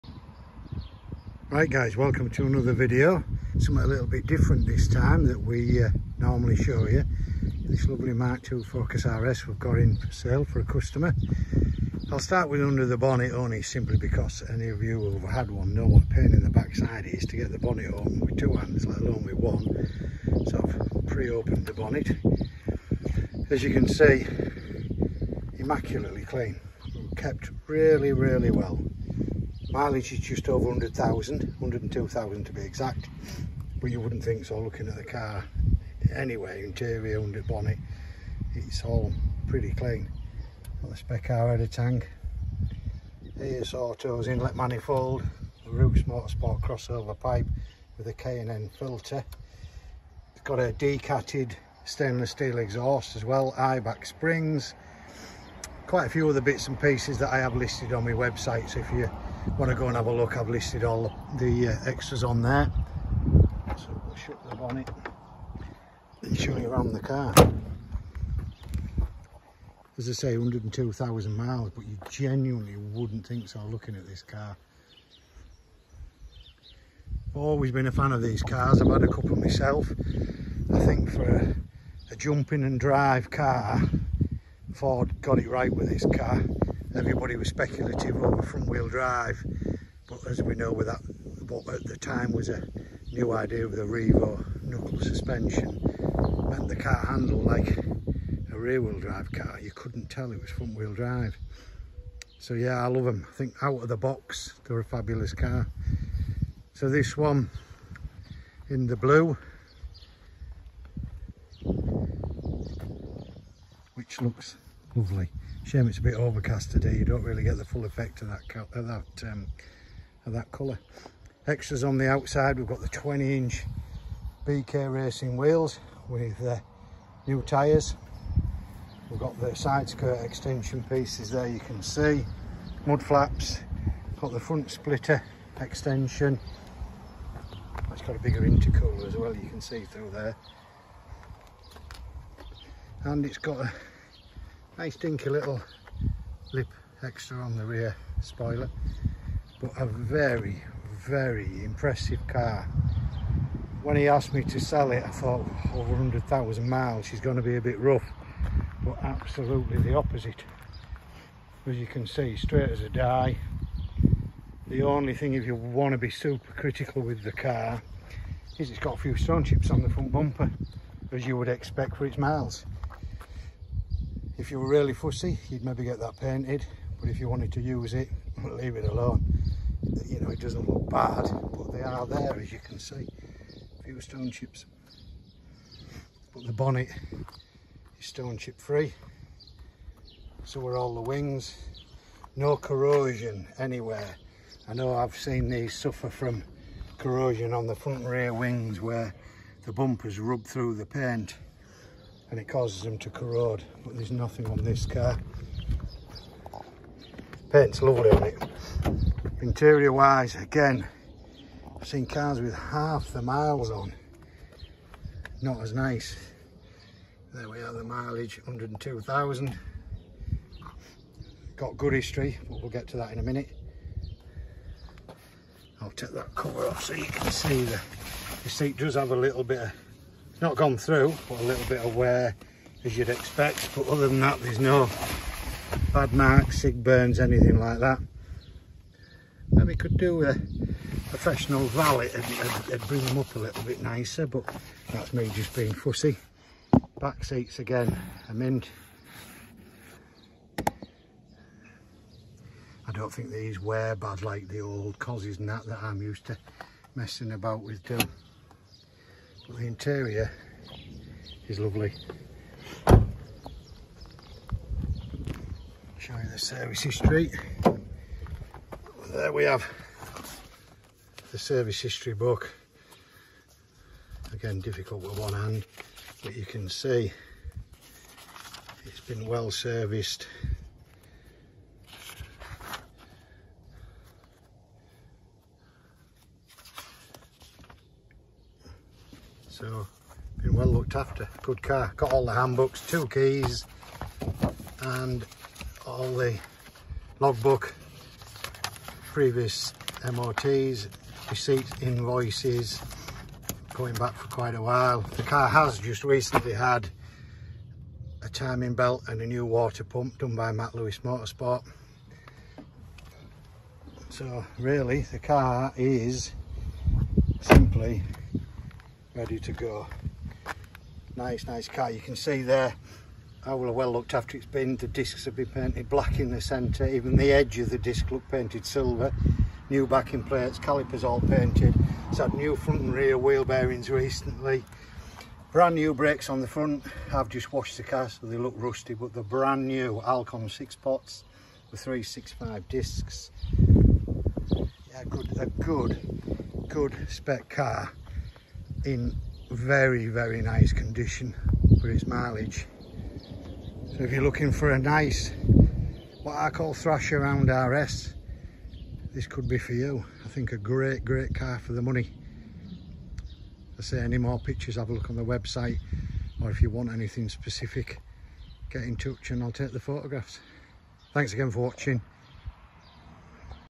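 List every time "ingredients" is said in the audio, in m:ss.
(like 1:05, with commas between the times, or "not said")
not said.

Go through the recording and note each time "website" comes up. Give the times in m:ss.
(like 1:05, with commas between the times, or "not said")
0:58, 6:05.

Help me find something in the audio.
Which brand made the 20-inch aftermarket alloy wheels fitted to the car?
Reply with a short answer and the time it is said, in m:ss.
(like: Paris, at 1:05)
BK Racing, at 2:04.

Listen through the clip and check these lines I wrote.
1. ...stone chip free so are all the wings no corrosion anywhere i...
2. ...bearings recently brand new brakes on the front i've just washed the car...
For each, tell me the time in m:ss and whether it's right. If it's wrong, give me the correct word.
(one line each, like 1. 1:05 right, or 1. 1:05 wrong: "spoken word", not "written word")
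1. 3:08 right
2. 5:33 right.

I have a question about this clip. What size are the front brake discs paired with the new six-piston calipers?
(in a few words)
365.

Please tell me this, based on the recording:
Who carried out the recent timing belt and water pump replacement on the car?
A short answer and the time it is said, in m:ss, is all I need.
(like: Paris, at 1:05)
Matt Lewis Motorsport, at 5:10.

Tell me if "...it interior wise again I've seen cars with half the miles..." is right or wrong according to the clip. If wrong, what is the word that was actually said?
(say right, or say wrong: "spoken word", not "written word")
right.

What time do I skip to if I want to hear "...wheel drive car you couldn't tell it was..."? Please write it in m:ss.
1:38.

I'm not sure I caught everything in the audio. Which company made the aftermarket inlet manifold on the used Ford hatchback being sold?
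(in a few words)
AS Autos.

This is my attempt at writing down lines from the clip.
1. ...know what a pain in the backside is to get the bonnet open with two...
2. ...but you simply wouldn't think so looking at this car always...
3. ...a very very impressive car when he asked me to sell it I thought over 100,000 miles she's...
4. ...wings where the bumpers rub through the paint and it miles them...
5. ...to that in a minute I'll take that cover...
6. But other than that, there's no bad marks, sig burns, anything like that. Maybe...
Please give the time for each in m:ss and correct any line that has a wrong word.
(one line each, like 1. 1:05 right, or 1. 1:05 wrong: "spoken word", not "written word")
1. 0:15 right
2. 1:11 wrong: "genuinely", not "simply"
3. 2:29 right
4. 3:18 wrong: "causes", not "miles"
5. 3:42 right
6. 3:53 right.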